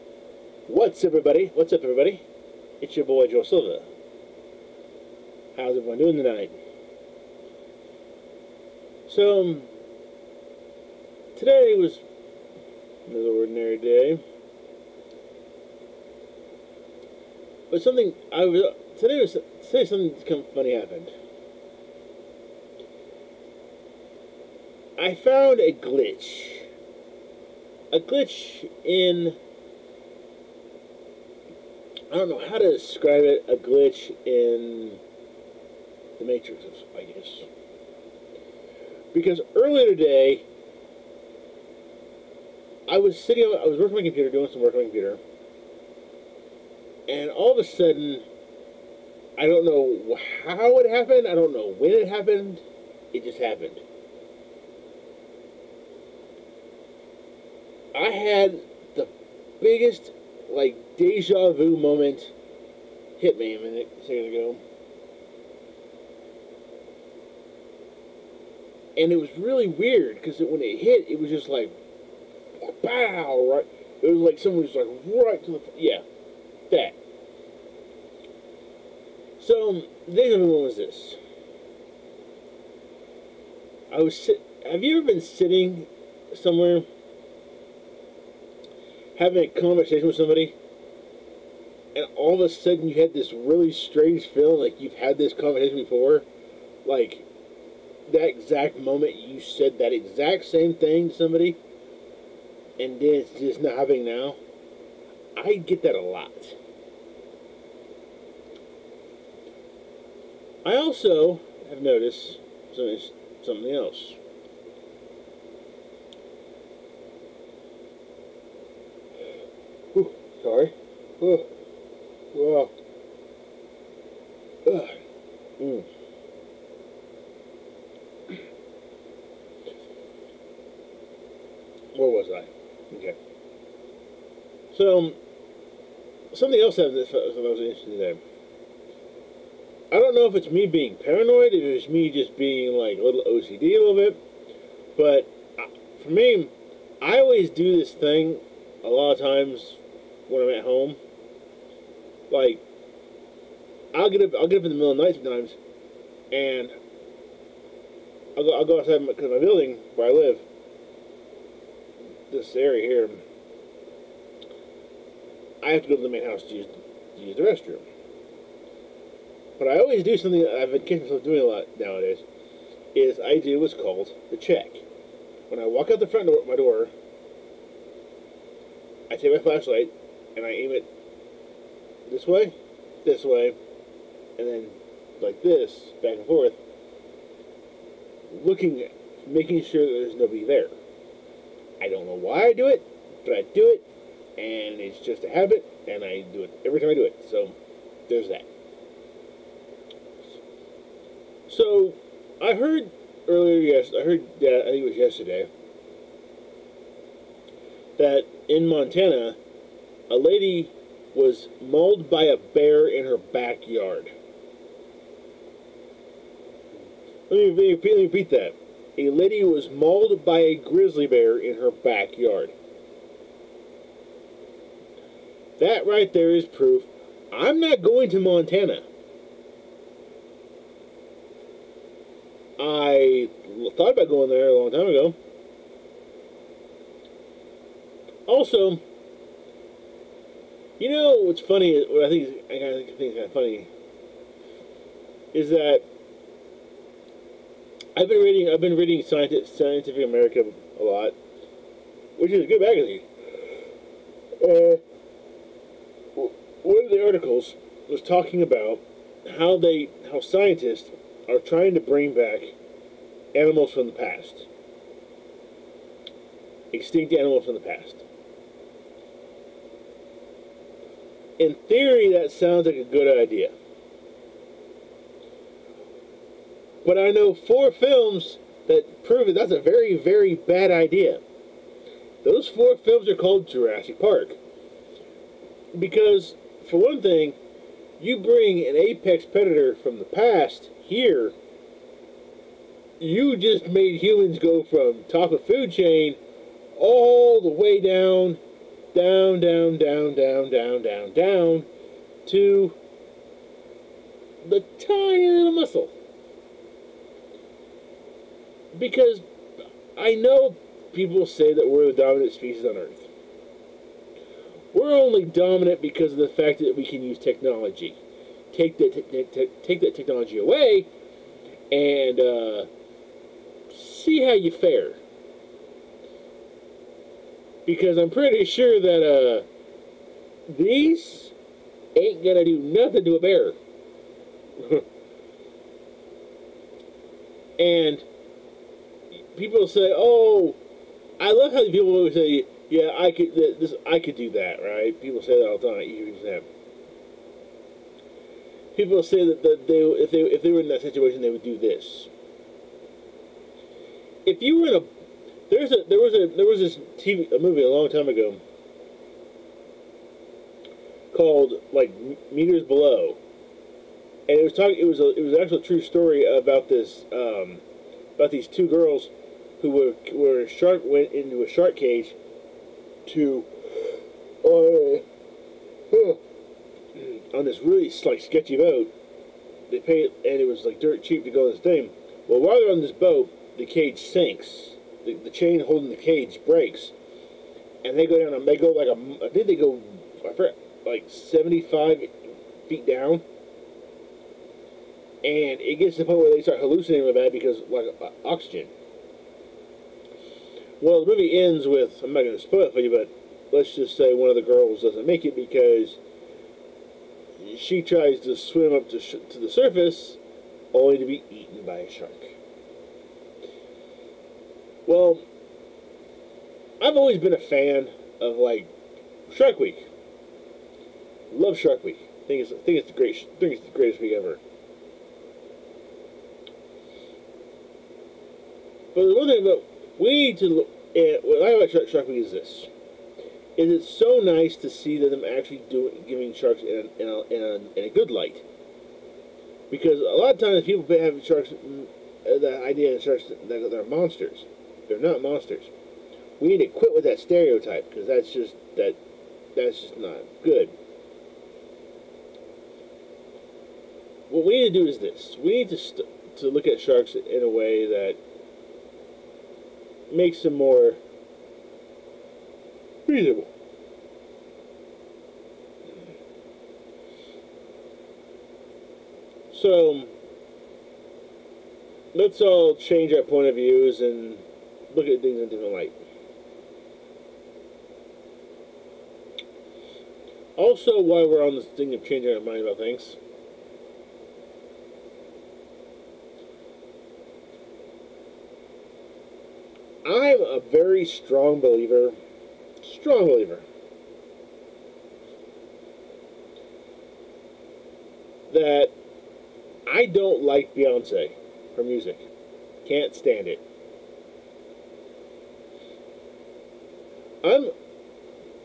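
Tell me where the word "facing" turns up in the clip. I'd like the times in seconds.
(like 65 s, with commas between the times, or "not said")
not said.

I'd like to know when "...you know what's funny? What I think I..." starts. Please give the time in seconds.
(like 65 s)
240 s.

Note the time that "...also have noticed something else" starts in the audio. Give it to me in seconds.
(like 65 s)
110 s.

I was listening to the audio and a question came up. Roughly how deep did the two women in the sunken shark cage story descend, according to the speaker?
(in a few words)
75 feet.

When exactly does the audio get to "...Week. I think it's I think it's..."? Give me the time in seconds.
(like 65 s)
421 s.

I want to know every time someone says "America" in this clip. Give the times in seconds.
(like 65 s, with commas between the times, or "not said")
250 s.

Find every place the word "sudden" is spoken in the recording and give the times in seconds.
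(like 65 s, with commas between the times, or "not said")
47 s, 92 s.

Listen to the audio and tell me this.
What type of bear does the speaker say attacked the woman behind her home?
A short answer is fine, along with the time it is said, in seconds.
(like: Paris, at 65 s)
grizzly bear, at 220 s.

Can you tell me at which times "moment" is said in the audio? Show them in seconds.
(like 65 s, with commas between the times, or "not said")
61 s, 98 s.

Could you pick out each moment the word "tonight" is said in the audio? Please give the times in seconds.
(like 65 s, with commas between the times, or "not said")
6 s.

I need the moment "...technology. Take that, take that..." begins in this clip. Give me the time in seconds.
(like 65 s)
317 s.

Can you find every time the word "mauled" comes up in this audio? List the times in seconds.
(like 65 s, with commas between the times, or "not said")
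211 s, 219 s.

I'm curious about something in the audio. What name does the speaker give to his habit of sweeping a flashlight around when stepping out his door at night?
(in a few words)
the check.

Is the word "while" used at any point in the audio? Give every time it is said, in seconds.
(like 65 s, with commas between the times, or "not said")
382 s, 481 s.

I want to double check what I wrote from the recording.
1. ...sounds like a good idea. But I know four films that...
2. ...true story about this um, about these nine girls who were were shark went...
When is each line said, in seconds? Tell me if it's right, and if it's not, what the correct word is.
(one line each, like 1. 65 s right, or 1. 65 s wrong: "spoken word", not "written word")
1. 272 s right
2. 365 s wrong: "two", not "nine".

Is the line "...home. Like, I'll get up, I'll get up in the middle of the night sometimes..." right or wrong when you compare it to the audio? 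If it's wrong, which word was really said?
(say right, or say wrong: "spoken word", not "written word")
right.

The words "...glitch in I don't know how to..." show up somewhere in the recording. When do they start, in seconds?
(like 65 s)
28 s.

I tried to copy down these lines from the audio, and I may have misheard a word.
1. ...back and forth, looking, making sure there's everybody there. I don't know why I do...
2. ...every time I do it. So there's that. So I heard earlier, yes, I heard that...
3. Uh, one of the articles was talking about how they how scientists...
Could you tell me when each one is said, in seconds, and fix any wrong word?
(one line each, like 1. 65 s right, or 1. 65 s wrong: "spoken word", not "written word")
1. 186 s wrong: "nobody", not "everybody"
2. 196 s right
3. 254 s right.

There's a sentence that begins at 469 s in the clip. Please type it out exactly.
So let's all change our point of views and look at things in a different light.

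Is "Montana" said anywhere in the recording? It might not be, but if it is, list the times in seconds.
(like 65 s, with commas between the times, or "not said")
208 s, 228 s.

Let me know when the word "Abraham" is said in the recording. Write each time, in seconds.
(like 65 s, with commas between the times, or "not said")
not said.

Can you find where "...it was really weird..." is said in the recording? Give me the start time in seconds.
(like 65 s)
69 s.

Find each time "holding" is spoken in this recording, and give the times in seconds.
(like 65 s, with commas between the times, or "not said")
385 s.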